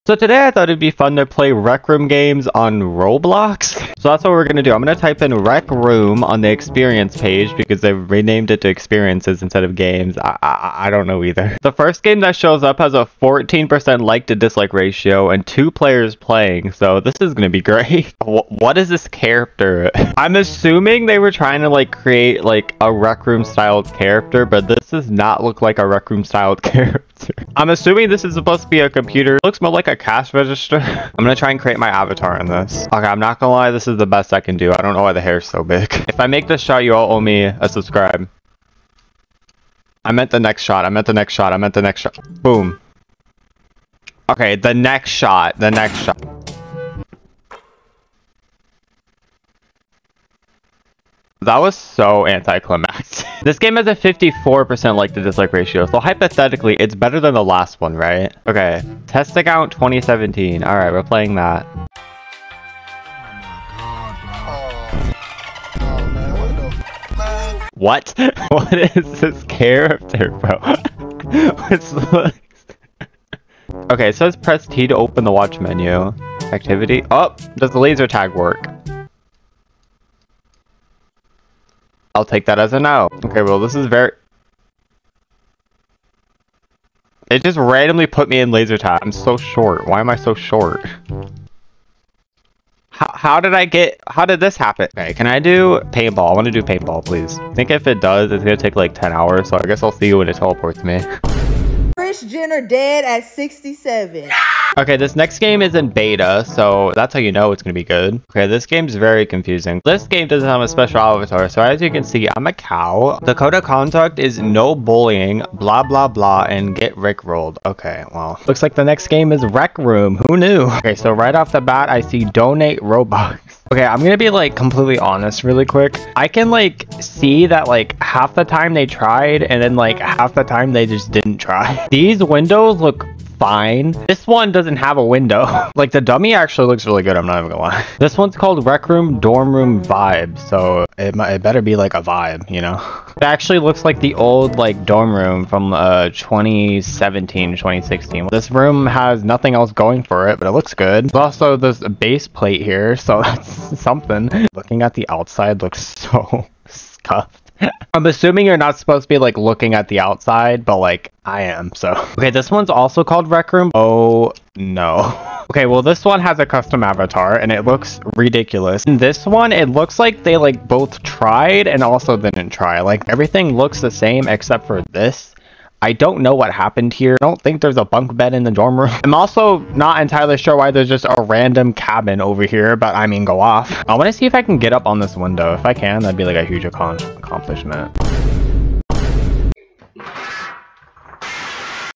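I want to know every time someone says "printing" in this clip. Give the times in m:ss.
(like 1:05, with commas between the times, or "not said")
not said.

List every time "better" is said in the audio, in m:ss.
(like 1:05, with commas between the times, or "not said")
0:56, 2:21.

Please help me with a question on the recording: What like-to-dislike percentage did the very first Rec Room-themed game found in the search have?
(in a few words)
14%.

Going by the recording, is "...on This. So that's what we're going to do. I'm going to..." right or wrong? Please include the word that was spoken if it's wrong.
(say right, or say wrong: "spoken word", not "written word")
wrong: "Roblox", not "This".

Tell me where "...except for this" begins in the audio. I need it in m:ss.
2:54.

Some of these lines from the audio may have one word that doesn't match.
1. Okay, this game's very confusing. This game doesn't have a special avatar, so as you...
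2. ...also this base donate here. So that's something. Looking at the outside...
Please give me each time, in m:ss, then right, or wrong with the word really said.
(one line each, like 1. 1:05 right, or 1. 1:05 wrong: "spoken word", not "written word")
1. 1:48 right
2. 2:31 wrong: "plate", not "donate".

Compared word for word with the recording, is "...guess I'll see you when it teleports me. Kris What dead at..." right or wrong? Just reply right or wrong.
wrong.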